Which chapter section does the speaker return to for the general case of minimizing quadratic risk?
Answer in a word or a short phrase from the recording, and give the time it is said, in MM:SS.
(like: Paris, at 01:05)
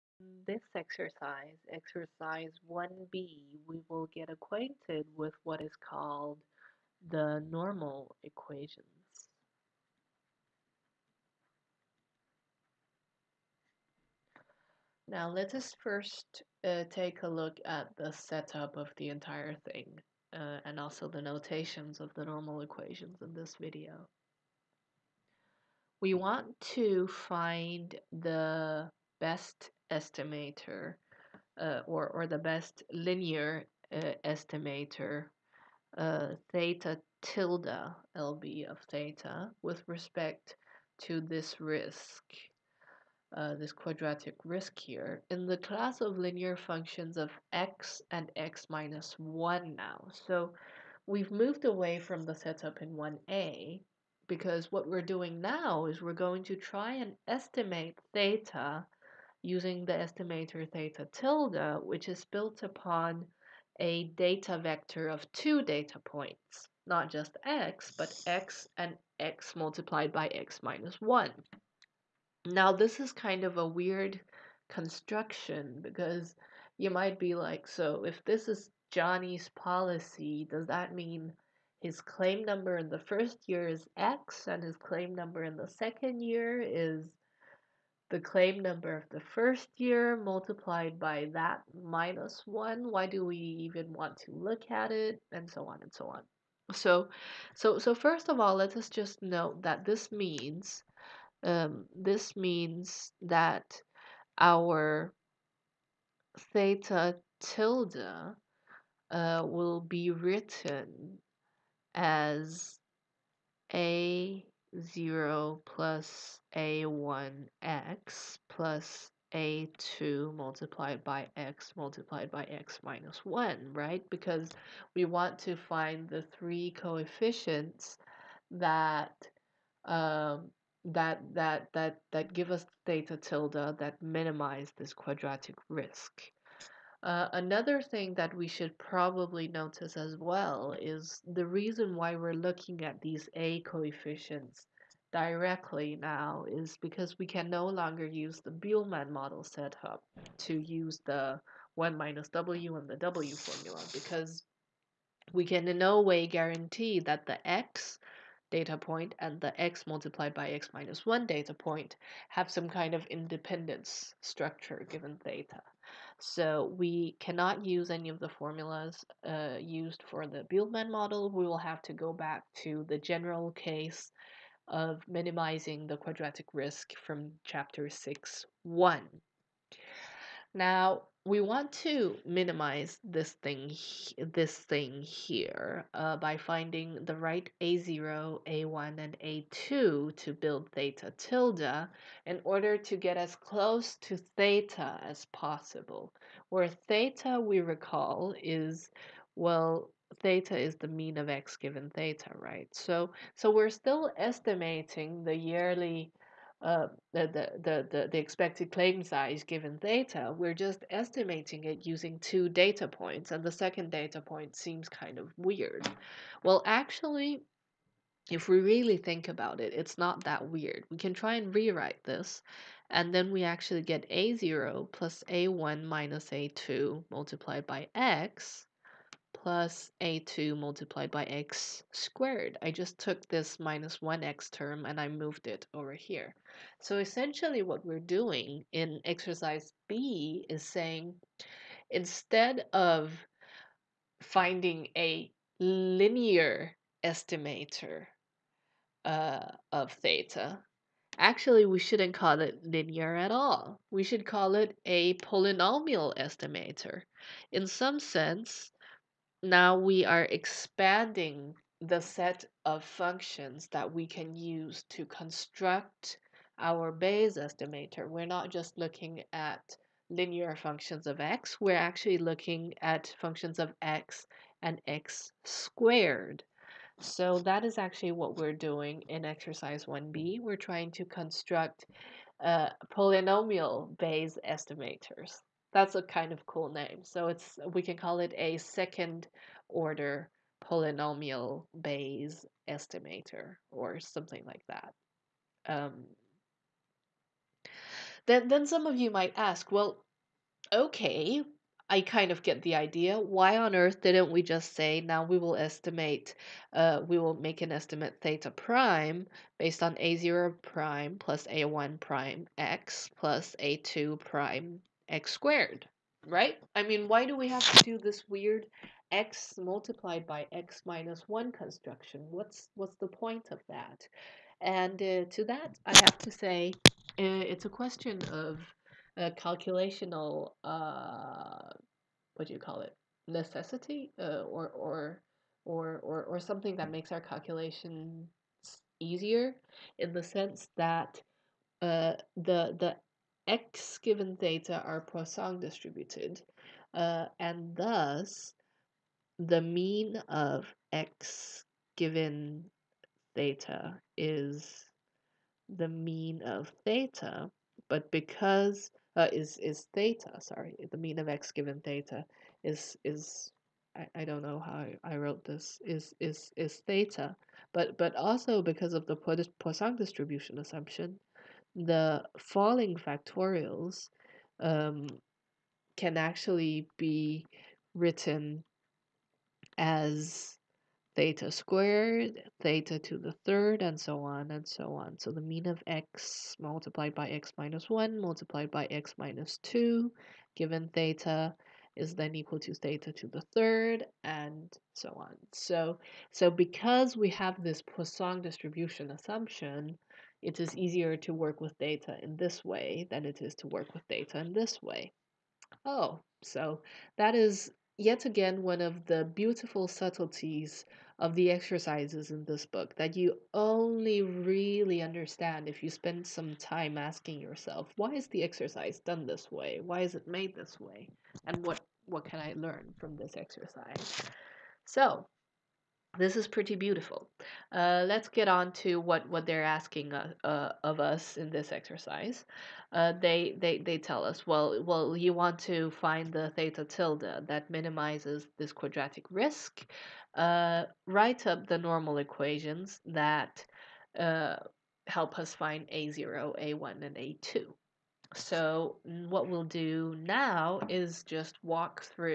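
Chapter 6.1, at 02:57.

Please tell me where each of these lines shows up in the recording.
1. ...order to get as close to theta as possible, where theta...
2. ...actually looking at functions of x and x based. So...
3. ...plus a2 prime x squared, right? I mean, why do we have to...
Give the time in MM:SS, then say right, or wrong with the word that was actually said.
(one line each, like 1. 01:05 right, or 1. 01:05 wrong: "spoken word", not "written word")
1. 03:12 right
2. 04:31 wrong: "squared", not "based"
3. 05:13 right.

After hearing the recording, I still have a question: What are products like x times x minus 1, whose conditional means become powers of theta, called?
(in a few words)
falling factorials.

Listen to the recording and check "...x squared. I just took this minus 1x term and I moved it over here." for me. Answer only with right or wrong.
right.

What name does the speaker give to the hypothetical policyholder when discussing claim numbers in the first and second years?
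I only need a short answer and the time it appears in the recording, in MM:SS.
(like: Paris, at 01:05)
Johnny, at 01:18.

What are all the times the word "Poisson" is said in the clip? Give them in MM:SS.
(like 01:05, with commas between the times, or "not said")
05:45, 06:09, 06:37.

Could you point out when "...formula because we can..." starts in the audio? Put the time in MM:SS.
02:33.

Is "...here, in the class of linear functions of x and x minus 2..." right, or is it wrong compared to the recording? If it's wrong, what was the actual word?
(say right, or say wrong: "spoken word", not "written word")
wrong: "1", not "2".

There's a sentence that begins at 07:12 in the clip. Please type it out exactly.
Uh, they, they, they tell us, well, well, you want to find the theta tilde that minimizes this quadratic risk.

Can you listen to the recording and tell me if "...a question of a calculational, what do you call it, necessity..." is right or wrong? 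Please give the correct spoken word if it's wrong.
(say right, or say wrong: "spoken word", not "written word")
right.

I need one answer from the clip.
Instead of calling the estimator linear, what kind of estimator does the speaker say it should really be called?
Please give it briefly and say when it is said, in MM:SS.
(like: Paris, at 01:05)
polynomial estimator, at 04:15.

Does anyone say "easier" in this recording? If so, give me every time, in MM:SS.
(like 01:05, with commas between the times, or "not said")
05:38, 06:40.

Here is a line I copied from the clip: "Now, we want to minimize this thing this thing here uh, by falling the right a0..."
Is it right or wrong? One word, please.
wrong.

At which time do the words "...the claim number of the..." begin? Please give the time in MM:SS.
01:28.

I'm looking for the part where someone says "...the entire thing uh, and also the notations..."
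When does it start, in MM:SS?
00:18.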